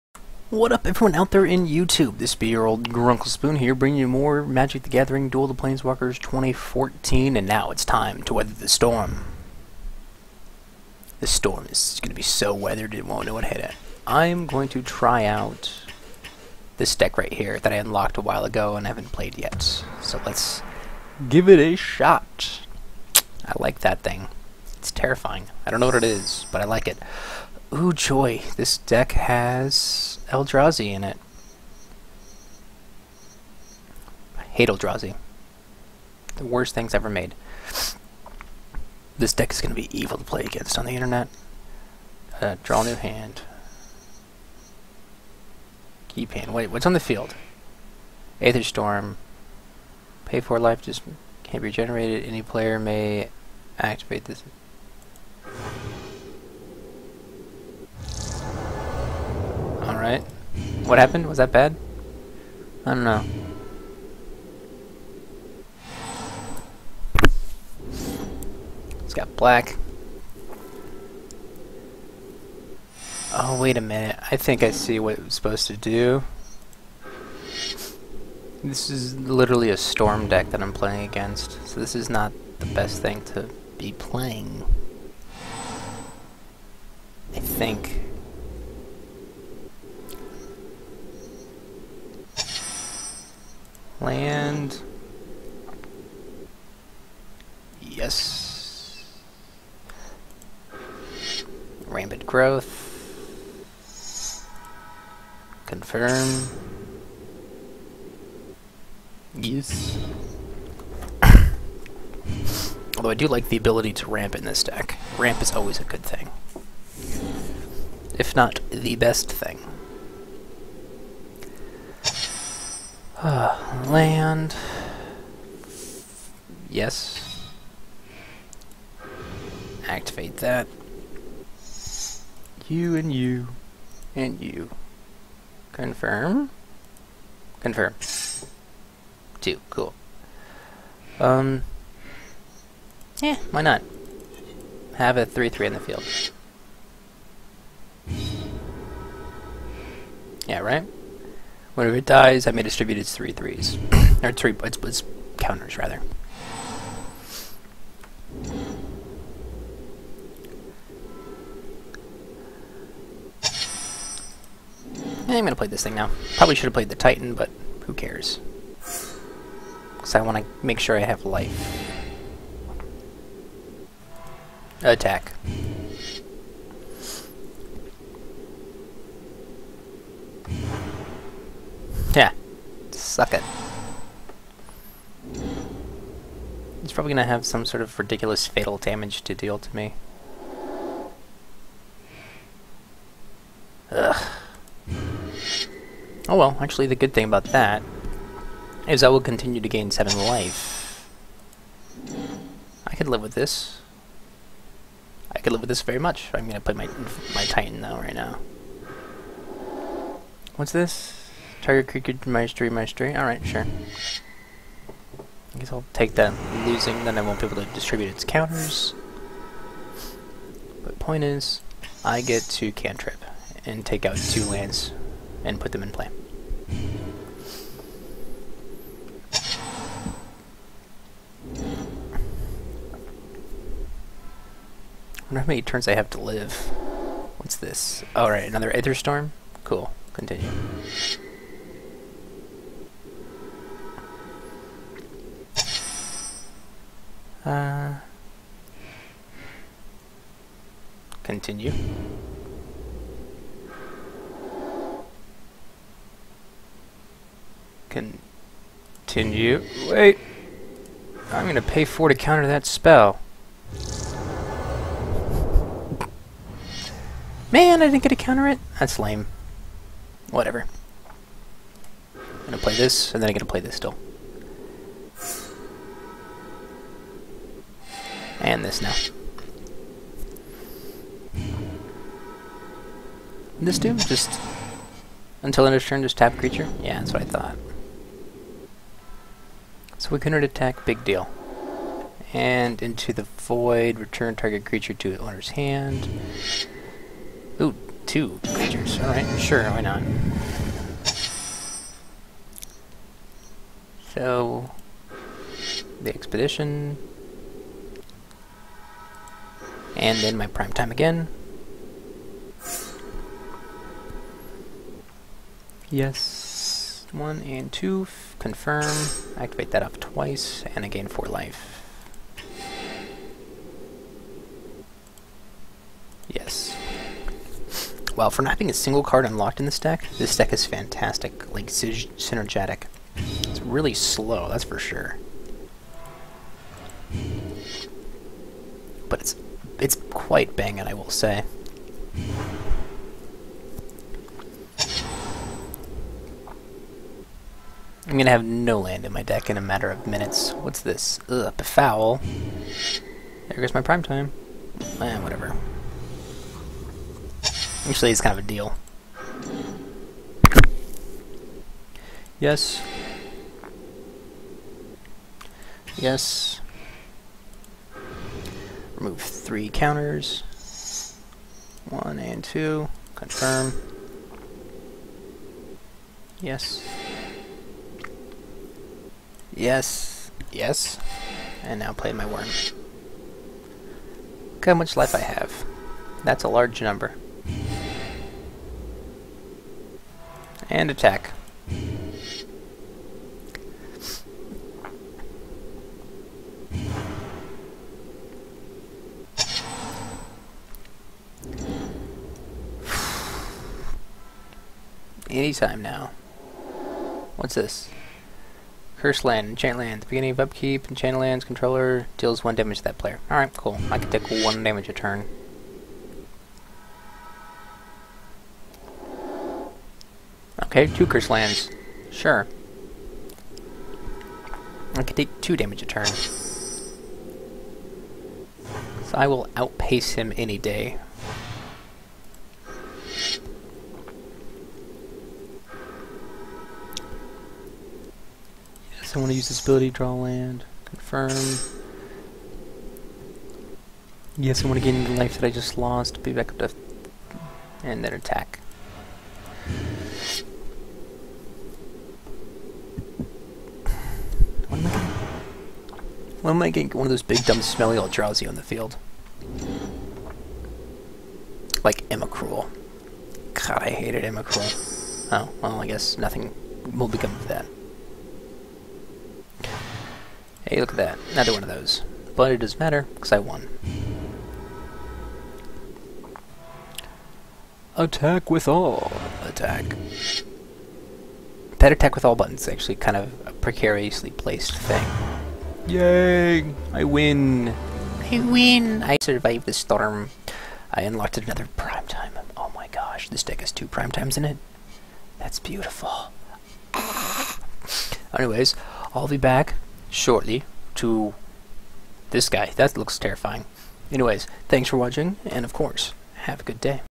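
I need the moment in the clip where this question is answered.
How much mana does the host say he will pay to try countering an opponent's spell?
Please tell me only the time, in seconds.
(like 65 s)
261 s.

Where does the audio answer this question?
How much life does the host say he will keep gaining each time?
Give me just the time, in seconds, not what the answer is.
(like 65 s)
199 s.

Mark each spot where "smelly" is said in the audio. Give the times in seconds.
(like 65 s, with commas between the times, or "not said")
457 s.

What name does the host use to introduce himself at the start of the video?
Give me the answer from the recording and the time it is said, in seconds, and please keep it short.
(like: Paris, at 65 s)
Grunkle Spoon, at 2 s.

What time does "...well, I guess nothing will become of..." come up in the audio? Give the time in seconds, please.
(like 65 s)
465 s.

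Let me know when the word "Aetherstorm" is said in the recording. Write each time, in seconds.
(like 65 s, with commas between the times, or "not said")
48 s, 238 s.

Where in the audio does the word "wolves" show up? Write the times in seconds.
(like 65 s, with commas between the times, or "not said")
not said.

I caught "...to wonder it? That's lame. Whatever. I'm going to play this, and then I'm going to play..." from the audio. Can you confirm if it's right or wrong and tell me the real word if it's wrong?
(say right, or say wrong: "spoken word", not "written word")
wrong: "counter", not "wonder".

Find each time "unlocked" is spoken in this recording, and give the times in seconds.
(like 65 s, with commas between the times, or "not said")
17 s, 329 s, 491 s.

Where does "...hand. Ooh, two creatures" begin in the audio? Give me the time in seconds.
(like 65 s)
295 s.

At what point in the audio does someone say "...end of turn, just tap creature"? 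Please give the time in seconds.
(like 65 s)
285 s.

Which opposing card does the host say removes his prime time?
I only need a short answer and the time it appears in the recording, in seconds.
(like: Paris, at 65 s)
Befoul, at 351 s.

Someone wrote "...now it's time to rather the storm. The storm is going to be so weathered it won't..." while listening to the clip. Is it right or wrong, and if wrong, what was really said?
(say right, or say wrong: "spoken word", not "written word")
wrong: "weather", not "rather".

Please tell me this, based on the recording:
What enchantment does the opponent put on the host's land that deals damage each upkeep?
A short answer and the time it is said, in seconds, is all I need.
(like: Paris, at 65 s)
Curse land, at 408 s.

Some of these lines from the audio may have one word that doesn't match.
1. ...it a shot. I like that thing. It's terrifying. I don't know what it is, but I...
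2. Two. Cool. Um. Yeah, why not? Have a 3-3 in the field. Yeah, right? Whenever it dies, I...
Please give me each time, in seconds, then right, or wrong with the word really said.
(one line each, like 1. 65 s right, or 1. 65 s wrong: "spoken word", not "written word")
1. 21 s right
2. 139 s right.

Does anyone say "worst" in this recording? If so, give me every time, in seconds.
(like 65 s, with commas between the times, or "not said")
36 s.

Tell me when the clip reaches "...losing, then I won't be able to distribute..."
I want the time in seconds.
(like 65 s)
216 s.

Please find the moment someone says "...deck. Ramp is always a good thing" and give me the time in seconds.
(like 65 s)
114 s.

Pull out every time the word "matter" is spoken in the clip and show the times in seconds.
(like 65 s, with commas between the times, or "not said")
349 s, 472 s.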